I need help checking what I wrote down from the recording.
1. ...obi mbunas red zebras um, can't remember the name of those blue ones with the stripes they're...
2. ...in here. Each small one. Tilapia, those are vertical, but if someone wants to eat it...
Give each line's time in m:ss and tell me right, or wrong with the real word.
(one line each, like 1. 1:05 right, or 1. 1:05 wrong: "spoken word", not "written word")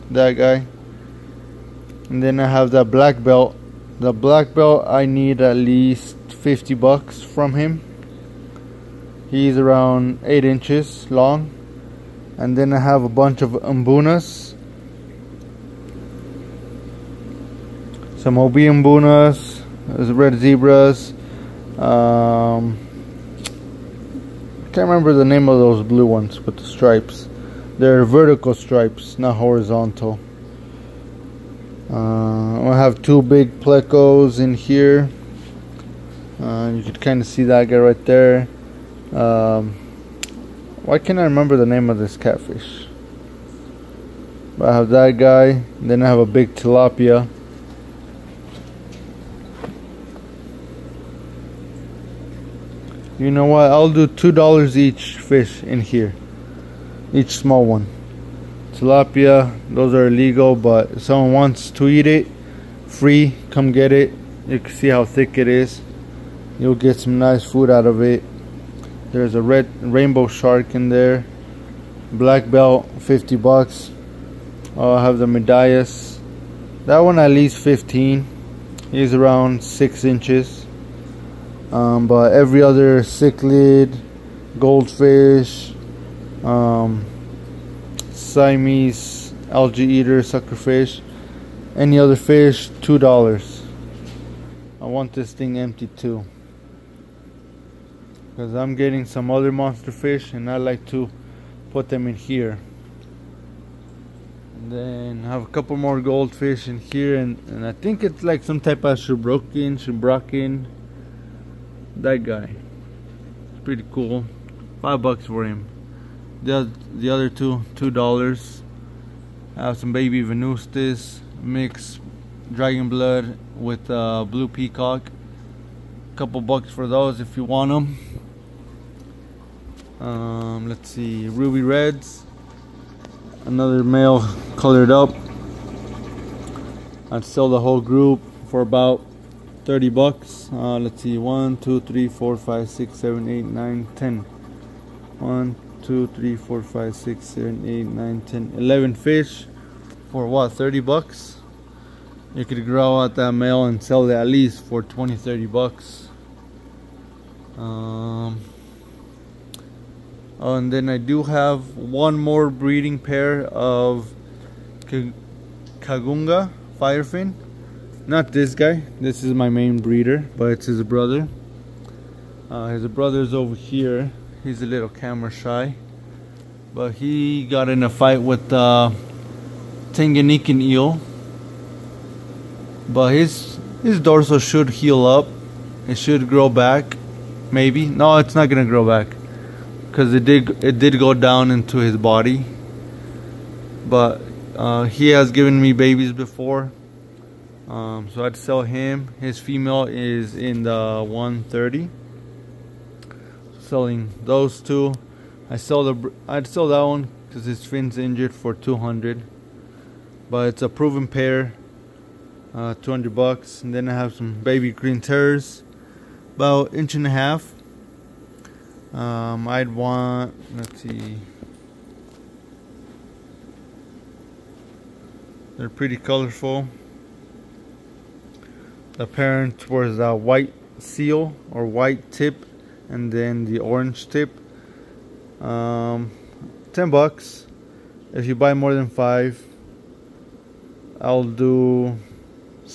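1. 0:18 right
2. 0:55 wrong: "illegal", not "vertical".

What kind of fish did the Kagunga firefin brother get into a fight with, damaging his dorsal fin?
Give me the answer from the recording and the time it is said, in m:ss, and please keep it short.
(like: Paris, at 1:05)
Tanganyikan eel, at 2:59.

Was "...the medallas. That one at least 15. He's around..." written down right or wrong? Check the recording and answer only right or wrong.
right.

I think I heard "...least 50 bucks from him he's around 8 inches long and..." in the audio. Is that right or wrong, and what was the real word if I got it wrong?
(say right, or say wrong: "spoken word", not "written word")
right.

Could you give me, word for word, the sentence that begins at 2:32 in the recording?
You could grow out that male and sell it at least for 20, 30 bucks.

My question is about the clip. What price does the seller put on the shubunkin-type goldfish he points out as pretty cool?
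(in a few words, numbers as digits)
$5.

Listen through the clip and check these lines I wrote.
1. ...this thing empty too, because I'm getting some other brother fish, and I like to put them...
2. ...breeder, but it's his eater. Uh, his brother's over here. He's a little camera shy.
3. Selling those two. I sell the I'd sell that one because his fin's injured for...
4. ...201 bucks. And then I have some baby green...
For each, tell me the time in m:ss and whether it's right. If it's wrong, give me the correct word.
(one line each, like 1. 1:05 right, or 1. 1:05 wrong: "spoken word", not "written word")
1. 1:35 wrong: "monster", not "brother"
2. 2:49 wrong: "brother", not "eater"
3. 3:23 right
4. 3:32 wrong: "200", not "201".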